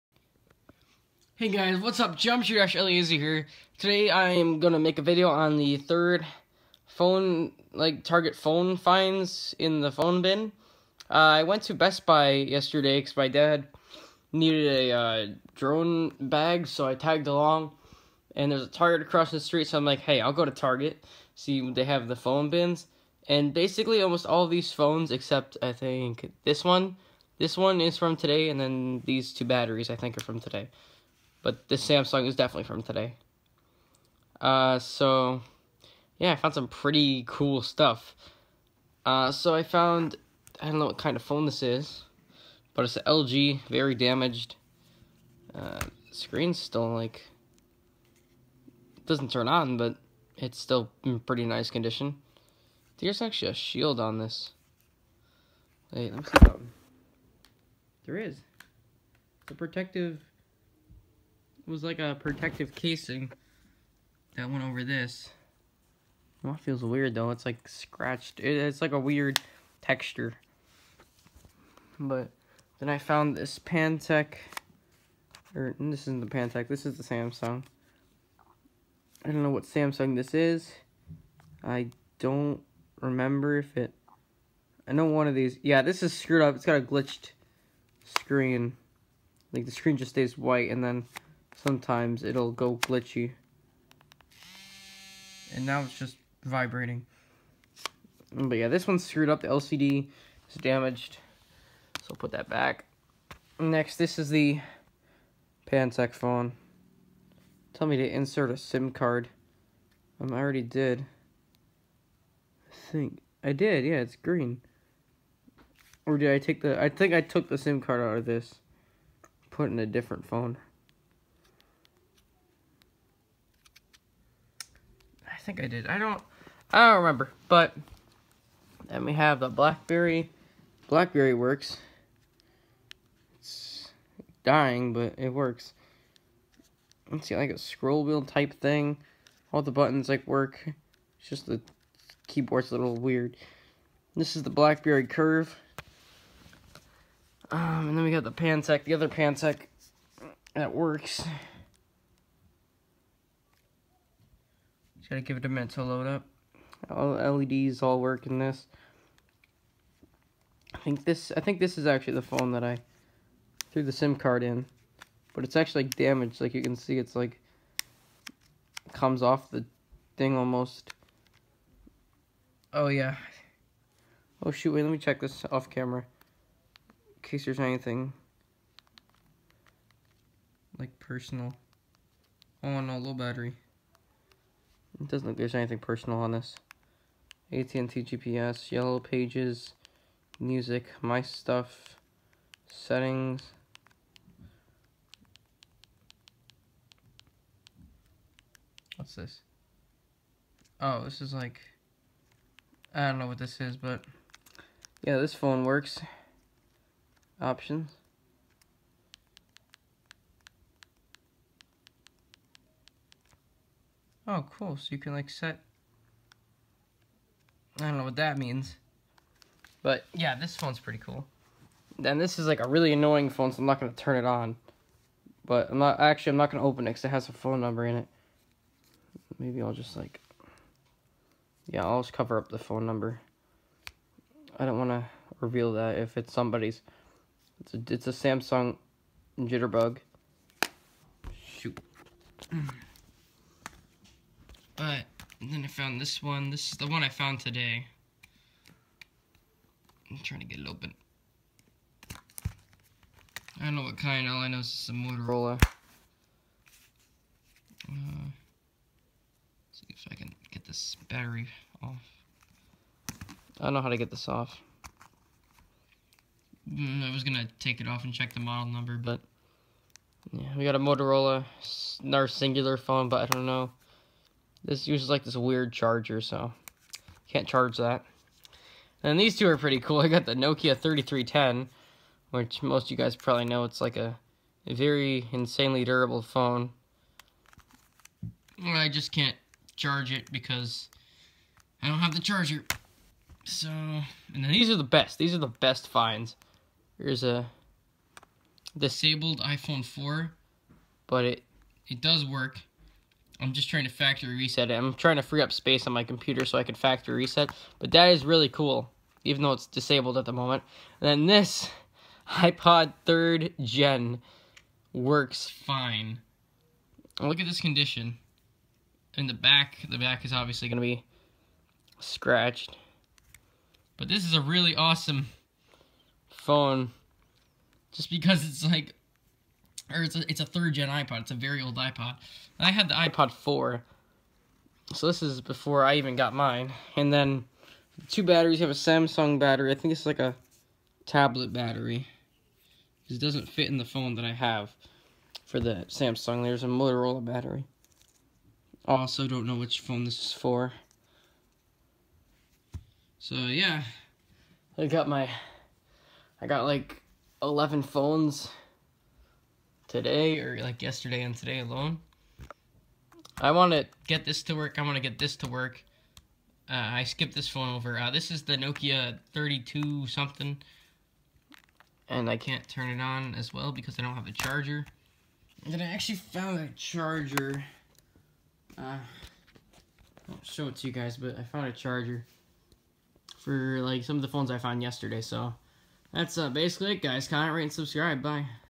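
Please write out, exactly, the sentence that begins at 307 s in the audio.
But that is really cool, even though it's disabled at the moment.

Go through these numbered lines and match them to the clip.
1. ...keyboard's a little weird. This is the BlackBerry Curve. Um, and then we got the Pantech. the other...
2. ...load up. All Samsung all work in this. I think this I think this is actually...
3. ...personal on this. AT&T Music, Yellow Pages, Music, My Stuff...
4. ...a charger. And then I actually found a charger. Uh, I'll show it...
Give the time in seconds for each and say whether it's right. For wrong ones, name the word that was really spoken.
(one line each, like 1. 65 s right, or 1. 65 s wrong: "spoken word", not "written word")
1. 142 s right
2. 155 s wrong: "LEDs", not "Samsung"
3. 185 s wrong: "GPS", not "Music"
4. 374 s right.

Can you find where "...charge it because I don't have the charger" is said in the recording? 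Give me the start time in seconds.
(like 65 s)
289 s.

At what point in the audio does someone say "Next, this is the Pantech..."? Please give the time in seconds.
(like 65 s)
103 s.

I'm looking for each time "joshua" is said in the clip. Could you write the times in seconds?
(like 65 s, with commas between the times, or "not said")
not said.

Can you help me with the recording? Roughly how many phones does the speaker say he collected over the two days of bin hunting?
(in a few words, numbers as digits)
11.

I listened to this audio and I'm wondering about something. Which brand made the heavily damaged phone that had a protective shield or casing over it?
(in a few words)
LG.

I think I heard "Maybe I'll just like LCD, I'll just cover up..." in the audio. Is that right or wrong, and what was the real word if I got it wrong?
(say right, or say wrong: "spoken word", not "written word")
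wrong: "Yeah", not "LCD".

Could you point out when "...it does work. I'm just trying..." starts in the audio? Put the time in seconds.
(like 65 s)
301 s.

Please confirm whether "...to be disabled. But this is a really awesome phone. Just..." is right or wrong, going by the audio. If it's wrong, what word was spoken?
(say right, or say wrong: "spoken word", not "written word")
wrong: "scratched", not "disabled".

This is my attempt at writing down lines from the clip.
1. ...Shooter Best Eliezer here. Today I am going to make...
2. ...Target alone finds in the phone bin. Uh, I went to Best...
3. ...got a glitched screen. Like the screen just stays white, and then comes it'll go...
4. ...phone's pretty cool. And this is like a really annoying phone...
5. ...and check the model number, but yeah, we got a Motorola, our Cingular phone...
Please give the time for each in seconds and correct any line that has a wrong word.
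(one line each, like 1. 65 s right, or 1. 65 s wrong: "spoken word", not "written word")
1. 2 s wrong: "Ash", not "Best"
2. 8 s wrong: "phone", not "alone"
3. 86 s wrong: "sometimes", not "comes"
4. 220 s right
5. 268 s right.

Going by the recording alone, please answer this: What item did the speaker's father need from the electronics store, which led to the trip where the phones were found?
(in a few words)
Drone bag.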